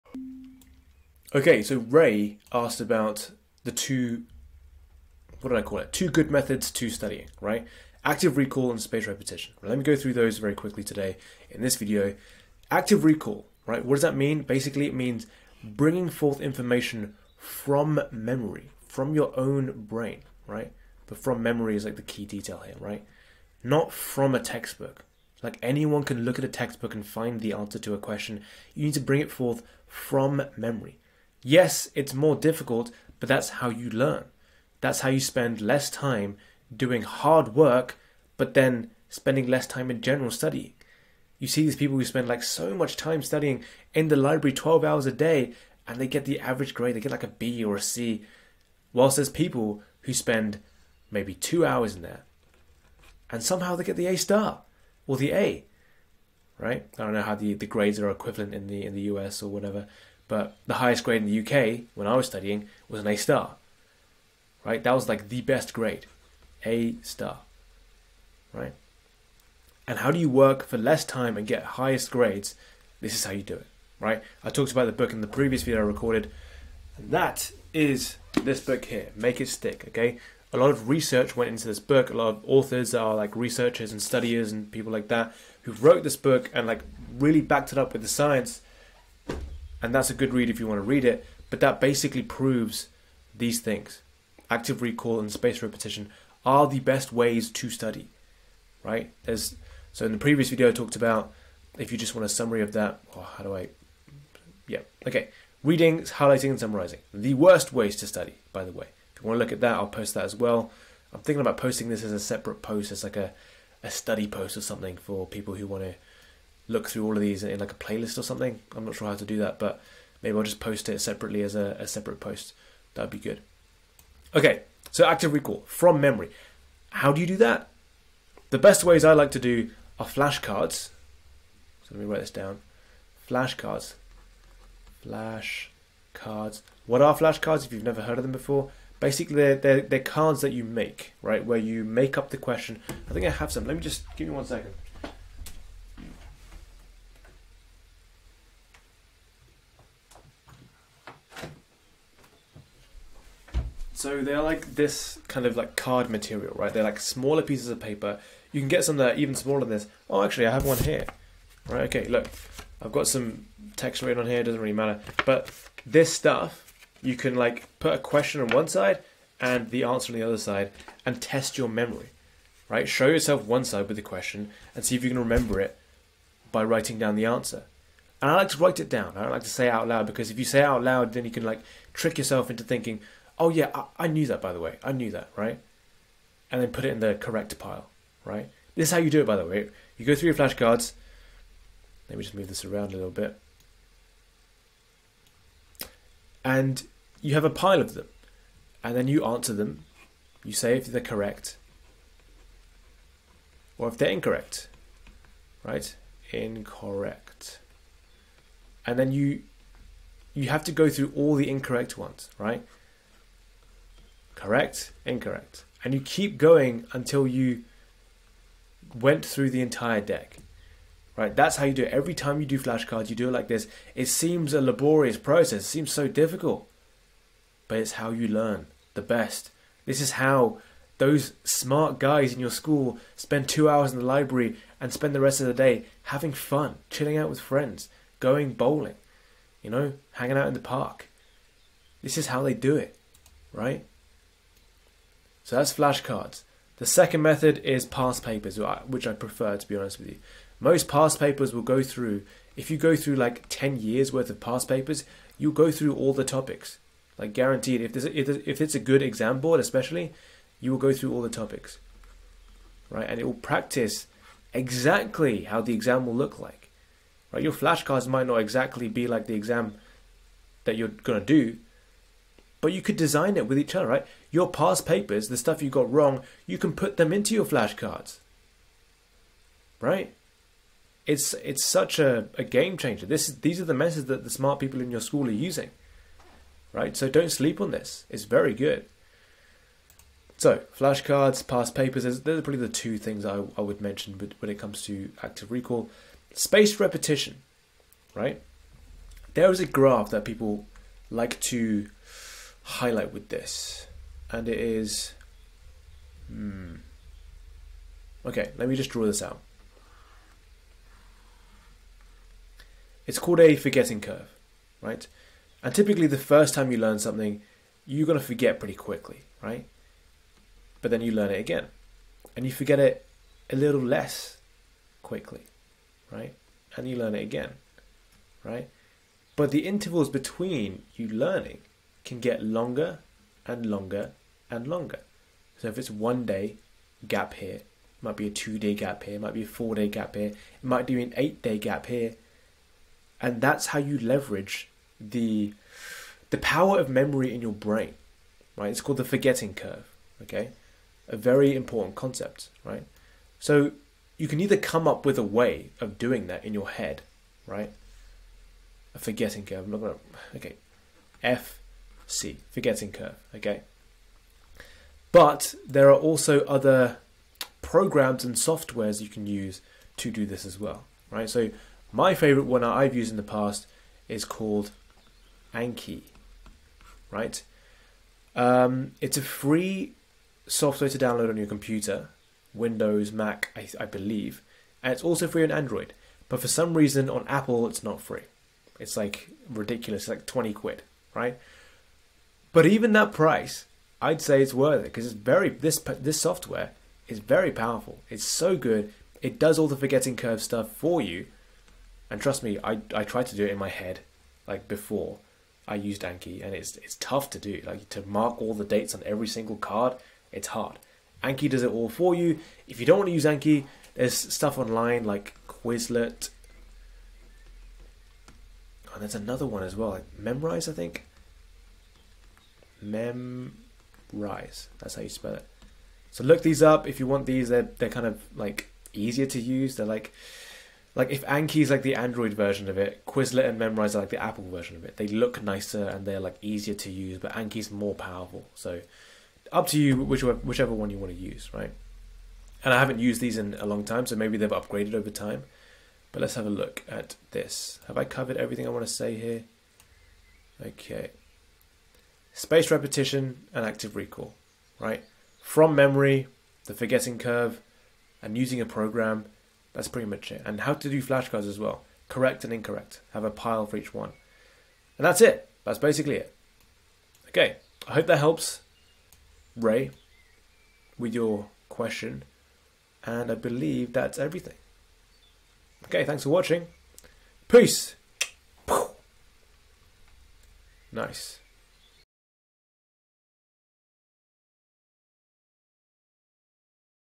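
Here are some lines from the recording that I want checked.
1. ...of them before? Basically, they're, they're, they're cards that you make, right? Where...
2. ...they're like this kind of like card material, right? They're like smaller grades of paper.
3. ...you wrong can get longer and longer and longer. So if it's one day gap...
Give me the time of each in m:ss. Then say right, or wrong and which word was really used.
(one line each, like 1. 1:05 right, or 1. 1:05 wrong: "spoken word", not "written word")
1. 2:18 right
2. 2:34 wrong: "pieces", not "grades"
3. 5:30 wrong: "learning", not "wrong".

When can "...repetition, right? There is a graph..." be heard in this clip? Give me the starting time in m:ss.
4:56.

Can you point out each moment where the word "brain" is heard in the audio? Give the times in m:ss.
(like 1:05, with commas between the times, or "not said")
0:19, 5:47.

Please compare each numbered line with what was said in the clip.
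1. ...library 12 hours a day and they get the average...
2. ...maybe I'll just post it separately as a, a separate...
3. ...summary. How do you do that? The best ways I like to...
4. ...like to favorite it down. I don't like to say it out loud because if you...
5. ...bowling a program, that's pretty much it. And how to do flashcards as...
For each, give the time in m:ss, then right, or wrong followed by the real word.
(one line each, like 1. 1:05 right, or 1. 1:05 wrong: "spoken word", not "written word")
1. 0:44 right
2. 2:00 right
3. 2:06 wrong: "memory", not "summary"
4. 2:58 wrong: "write", not "favorite"
5. 7:38 wrong: "using", not "bowling".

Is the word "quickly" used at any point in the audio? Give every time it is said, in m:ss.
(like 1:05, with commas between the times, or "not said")
0:10, 5:18, 5:25.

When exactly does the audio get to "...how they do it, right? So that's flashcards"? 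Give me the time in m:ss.
4:02.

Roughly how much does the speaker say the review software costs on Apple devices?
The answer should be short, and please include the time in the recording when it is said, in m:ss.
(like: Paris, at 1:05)
20 quid, at 6:30.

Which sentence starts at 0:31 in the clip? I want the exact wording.
Yes, it's more difficult, but that's how you learn.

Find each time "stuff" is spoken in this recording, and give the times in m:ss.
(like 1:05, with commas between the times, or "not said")
2:46, 4:35, 6:40, 6:54.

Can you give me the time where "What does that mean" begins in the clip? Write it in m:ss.
0:13.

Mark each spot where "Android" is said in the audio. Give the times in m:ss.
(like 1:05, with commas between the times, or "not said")
6:25, 7:11.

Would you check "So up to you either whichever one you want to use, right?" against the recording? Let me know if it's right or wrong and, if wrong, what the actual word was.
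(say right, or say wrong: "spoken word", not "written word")
wrong: "whichever", not "either".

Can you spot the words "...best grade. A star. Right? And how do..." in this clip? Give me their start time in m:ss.
1:05.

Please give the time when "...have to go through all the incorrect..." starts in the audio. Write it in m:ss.
3:30.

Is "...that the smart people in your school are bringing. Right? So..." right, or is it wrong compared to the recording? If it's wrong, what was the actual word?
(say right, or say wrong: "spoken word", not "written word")
wrong: "using", not "bringing".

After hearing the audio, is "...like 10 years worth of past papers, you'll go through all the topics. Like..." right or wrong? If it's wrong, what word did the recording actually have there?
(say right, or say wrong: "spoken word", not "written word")
right.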